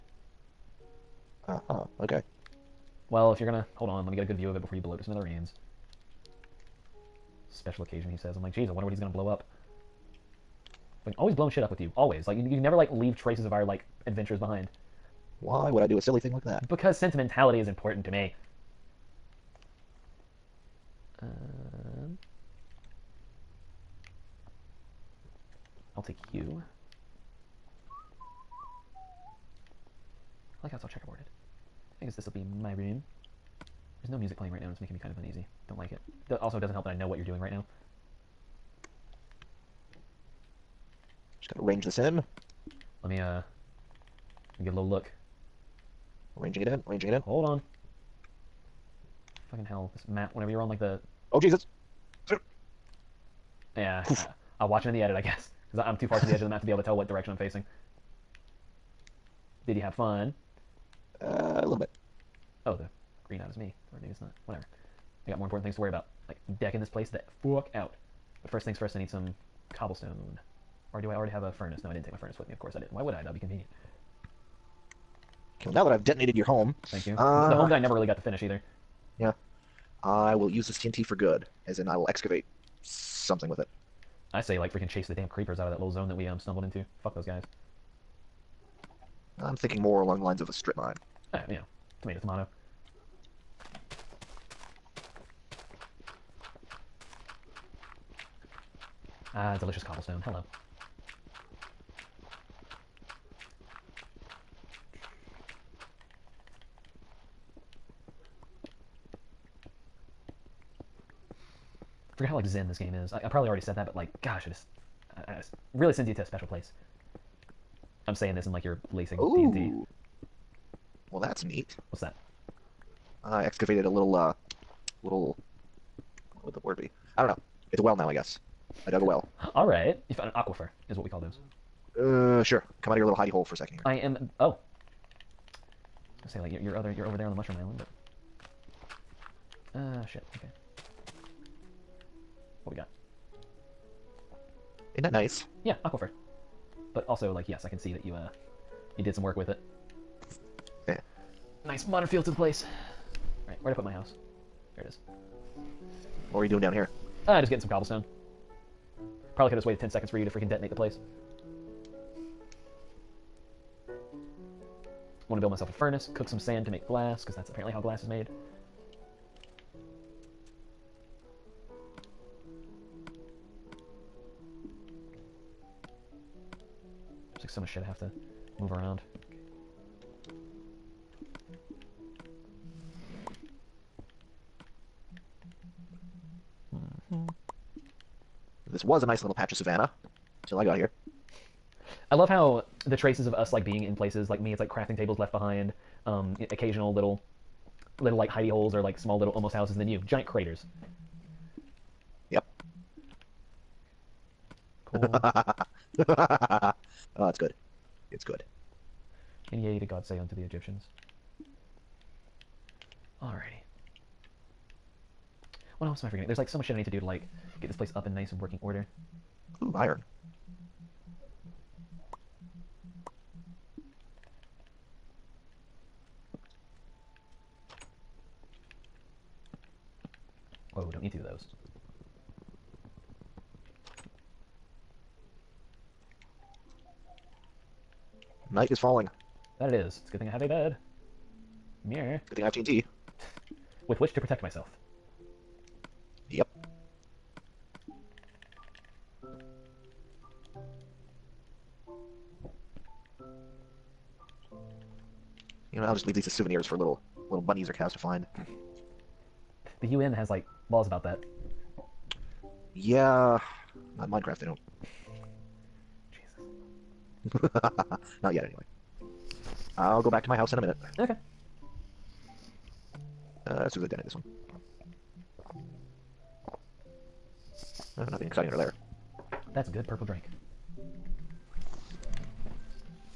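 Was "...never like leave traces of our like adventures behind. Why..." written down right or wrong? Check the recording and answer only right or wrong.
right.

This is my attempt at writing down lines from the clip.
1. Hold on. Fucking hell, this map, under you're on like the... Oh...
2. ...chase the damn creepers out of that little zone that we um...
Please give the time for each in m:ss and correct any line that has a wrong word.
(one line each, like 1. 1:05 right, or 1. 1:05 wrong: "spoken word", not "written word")
1. 0:47 wrong: "whenever", not "under"
2. 1:24 right.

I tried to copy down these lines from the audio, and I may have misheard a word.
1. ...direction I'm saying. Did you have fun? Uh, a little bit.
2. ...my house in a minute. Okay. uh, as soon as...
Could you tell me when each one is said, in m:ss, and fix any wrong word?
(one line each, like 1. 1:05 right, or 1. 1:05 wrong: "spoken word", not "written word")
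1. 0:57 wrong: "facing", not "saying"
2. 4:30 right.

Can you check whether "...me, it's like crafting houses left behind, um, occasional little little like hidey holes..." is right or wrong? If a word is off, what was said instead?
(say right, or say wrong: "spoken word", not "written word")
wrong: "tables", not "houses".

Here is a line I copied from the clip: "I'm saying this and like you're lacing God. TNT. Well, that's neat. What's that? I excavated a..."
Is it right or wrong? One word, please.
wrong.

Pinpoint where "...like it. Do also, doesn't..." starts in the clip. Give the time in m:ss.
0:35.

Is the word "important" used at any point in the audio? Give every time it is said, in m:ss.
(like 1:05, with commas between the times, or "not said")
0:17, 1:05.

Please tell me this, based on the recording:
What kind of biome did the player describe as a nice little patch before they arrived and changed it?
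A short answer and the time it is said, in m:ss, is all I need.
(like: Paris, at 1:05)
Savannah, at 3:09.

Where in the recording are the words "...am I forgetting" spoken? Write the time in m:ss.
3:36.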